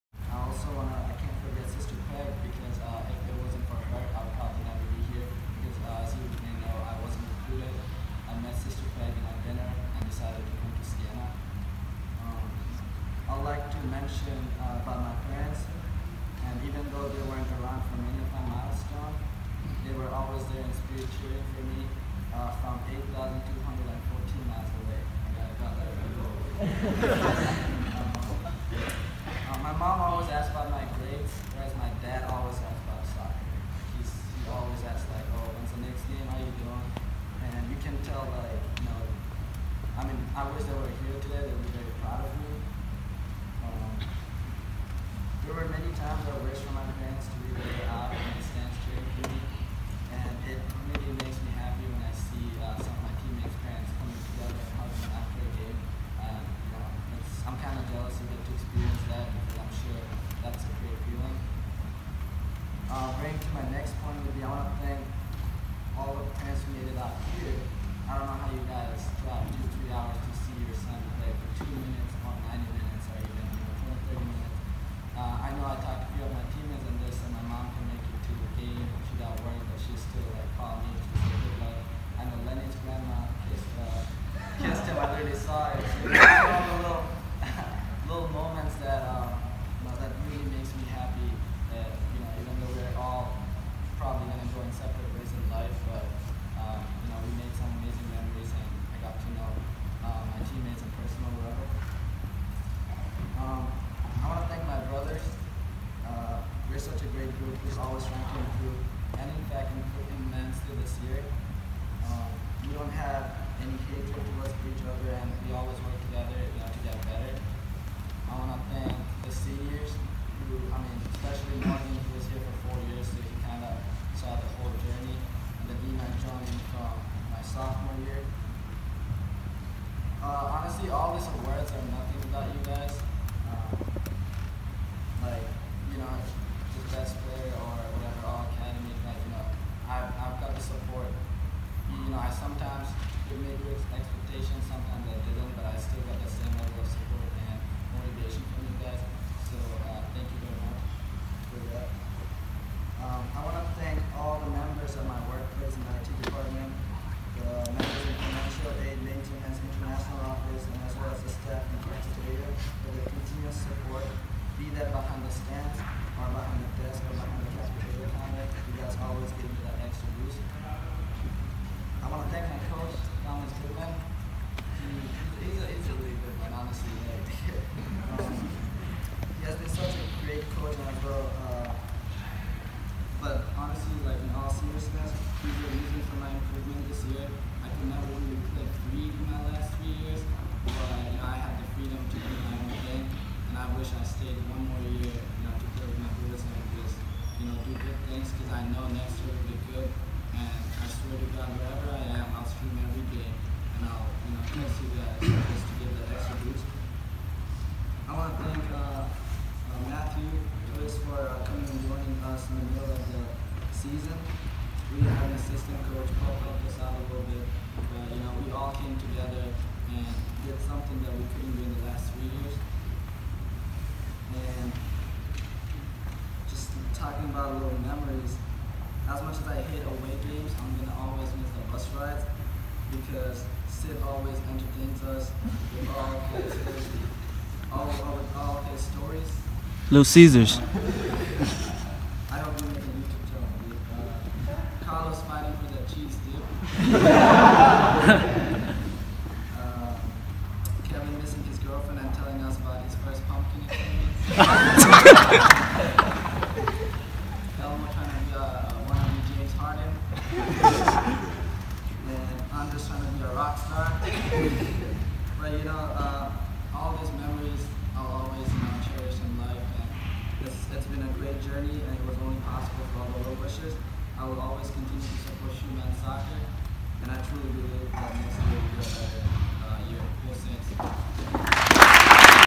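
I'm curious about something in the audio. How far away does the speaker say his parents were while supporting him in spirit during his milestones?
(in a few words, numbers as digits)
8,214 miles.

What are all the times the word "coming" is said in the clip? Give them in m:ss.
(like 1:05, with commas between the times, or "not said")
0:53, 3:31.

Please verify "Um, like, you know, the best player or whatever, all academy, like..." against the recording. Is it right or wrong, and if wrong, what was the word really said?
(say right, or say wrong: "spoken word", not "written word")
right.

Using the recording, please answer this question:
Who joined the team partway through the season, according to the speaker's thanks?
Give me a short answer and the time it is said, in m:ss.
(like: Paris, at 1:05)
Matthew Twist, at 3:29.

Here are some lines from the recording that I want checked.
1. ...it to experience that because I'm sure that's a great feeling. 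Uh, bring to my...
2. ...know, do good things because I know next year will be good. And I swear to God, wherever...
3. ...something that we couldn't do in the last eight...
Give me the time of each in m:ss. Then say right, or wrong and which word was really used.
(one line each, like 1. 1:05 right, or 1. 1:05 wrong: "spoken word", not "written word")
1. 0:58 right
2. 3:17 right
3. 3:40 wrong: "three", not "eight".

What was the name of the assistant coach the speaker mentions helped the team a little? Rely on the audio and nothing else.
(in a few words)
Paul.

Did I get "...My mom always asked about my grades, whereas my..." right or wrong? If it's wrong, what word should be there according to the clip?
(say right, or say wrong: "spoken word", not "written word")
right.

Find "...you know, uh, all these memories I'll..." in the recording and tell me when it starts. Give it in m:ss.
4:25.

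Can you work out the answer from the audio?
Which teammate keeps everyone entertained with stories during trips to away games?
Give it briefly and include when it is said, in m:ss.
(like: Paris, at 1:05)
Sid, at 3:53.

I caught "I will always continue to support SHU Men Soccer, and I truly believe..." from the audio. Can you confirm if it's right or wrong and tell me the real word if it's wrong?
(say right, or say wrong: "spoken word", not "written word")
right.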